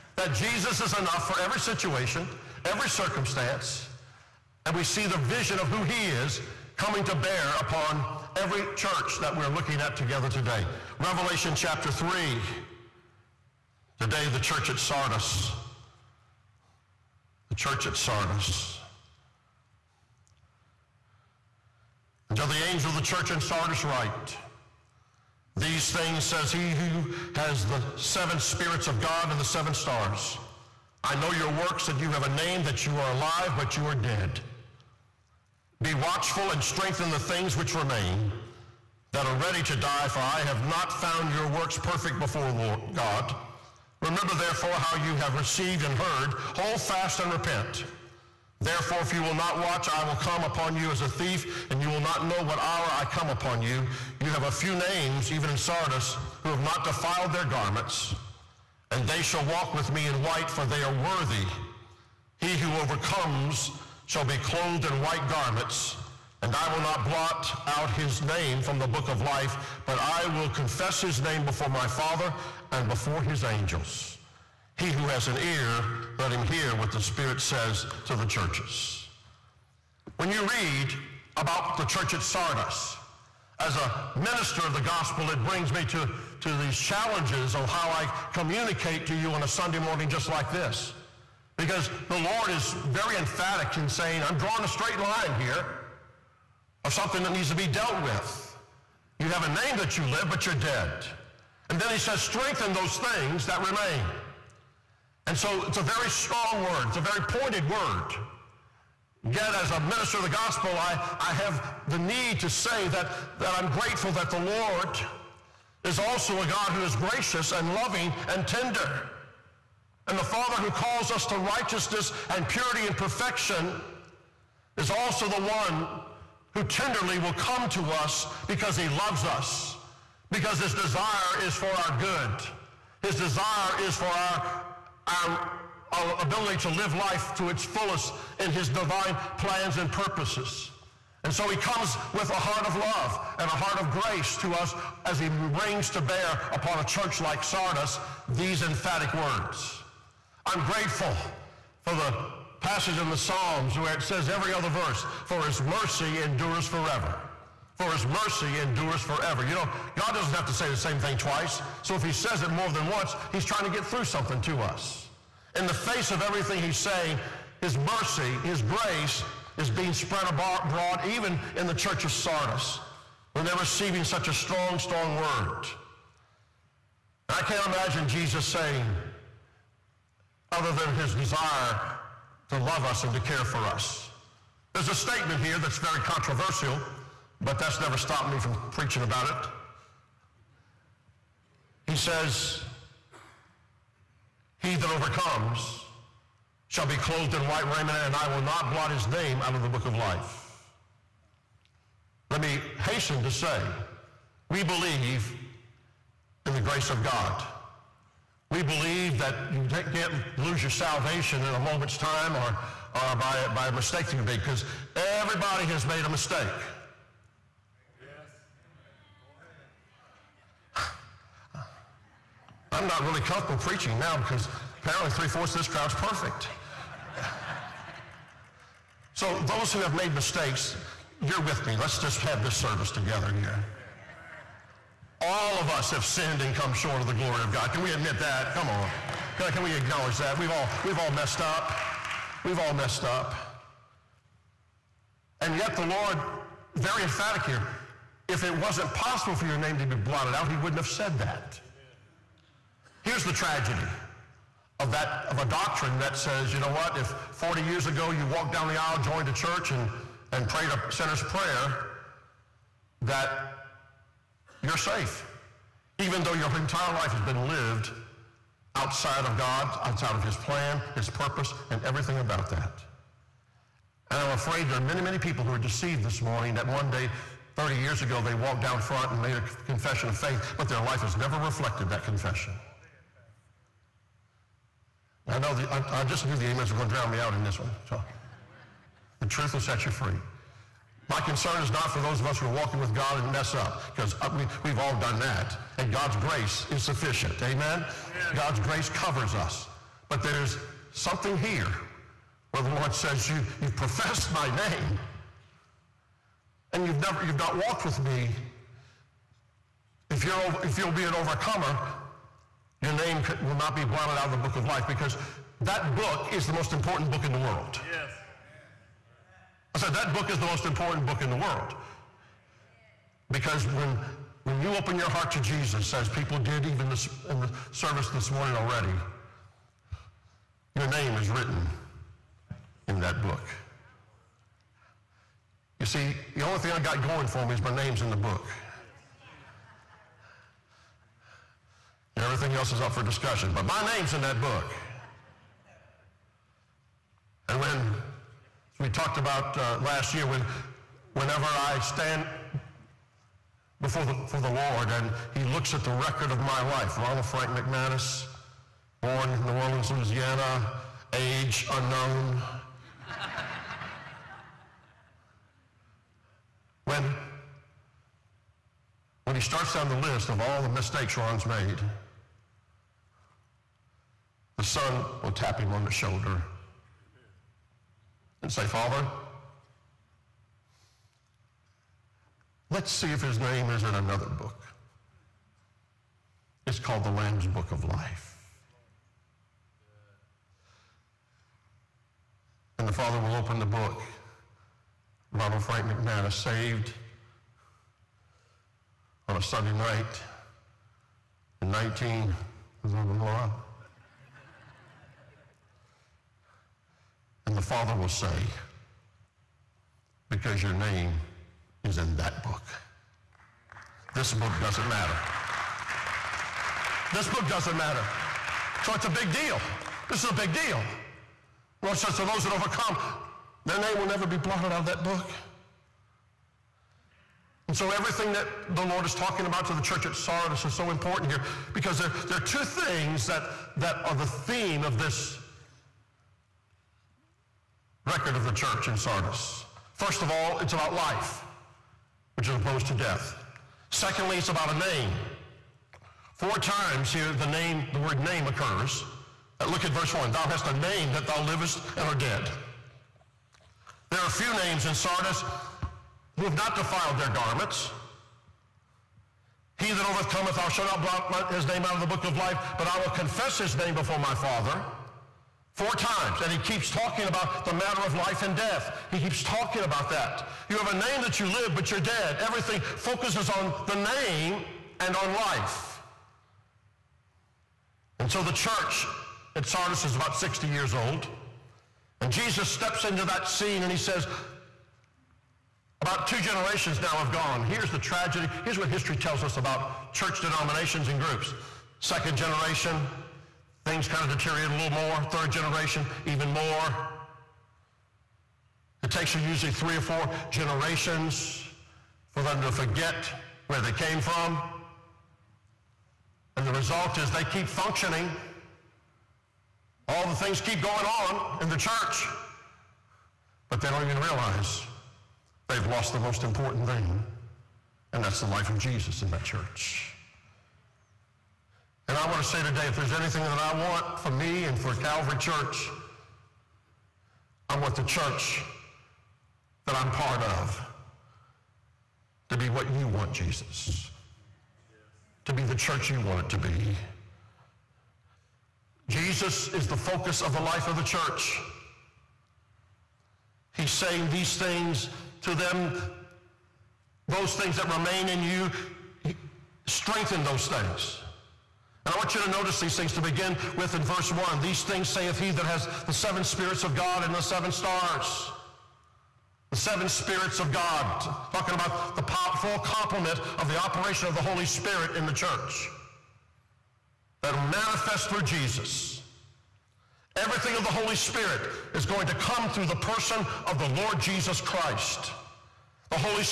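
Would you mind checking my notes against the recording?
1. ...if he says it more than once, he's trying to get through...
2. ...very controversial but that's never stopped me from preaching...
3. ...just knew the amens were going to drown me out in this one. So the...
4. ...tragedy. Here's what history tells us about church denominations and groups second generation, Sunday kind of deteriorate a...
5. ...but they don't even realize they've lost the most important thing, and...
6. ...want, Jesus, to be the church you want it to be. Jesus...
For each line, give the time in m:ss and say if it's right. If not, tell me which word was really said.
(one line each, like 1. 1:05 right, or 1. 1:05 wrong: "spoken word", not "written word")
1. 2:41 right
2. 3:05 right
3. 4:46 right
4. 8:07 wrong: "Things", not "Sunday"
5. 8:33 right
6. 8:53 right.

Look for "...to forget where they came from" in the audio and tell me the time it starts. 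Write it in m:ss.
8:22.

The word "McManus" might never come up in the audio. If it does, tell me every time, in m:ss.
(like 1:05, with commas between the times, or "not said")
5:57, 6:35.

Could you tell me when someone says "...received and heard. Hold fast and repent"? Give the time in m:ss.
0:45.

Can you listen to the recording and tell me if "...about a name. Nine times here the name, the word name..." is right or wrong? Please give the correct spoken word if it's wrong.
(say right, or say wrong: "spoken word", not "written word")
wrong: "Four", not "Nine".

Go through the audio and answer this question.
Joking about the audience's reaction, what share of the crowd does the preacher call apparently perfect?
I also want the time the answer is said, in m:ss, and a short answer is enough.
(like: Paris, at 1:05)
three fourths, at 3:45.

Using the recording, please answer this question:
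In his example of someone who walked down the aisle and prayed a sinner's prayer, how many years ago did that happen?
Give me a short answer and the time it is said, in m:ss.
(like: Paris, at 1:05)
40, at 4:17.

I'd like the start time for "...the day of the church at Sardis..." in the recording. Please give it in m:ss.
0:13.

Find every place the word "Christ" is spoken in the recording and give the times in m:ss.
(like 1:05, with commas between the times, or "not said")
9:34.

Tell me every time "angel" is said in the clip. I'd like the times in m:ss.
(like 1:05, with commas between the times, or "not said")
0:22, 1:13.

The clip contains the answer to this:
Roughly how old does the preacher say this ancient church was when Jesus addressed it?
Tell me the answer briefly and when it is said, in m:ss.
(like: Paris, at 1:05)
about 60 years, at 8:00.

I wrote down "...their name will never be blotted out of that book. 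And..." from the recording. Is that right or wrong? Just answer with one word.
right.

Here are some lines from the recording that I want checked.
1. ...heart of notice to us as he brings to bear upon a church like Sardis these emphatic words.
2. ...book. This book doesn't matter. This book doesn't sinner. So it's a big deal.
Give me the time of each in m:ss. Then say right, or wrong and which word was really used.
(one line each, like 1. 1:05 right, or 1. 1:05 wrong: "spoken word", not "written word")
1. 2:23 wrong: "grace", not "notice"
2. 6:52 wrong: "matter", not "sinner".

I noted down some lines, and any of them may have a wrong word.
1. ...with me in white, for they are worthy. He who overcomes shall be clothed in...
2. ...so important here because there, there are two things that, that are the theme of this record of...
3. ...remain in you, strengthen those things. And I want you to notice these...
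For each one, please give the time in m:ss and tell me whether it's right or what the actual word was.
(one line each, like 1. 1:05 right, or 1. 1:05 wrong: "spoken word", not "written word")
1. 0:59 right
2. 7:10 right
3. 9:07 right.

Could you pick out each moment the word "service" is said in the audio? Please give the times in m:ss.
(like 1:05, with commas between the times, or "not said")
3:52, 5:27.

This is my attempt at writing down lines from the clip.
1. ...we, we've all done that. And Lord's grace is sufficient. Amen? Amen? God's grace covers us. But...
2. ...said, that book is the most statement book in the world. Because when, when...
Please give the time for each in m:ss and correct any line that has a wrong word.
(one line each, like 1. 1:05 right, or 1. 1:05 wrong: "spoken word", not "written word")
1. 4:54 wrong: "God", not "Lord"
2. 5:19 wrong: "important", not "statement".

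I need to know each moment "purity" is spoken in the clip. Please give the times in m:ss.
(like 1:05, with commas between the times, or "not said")
2:02.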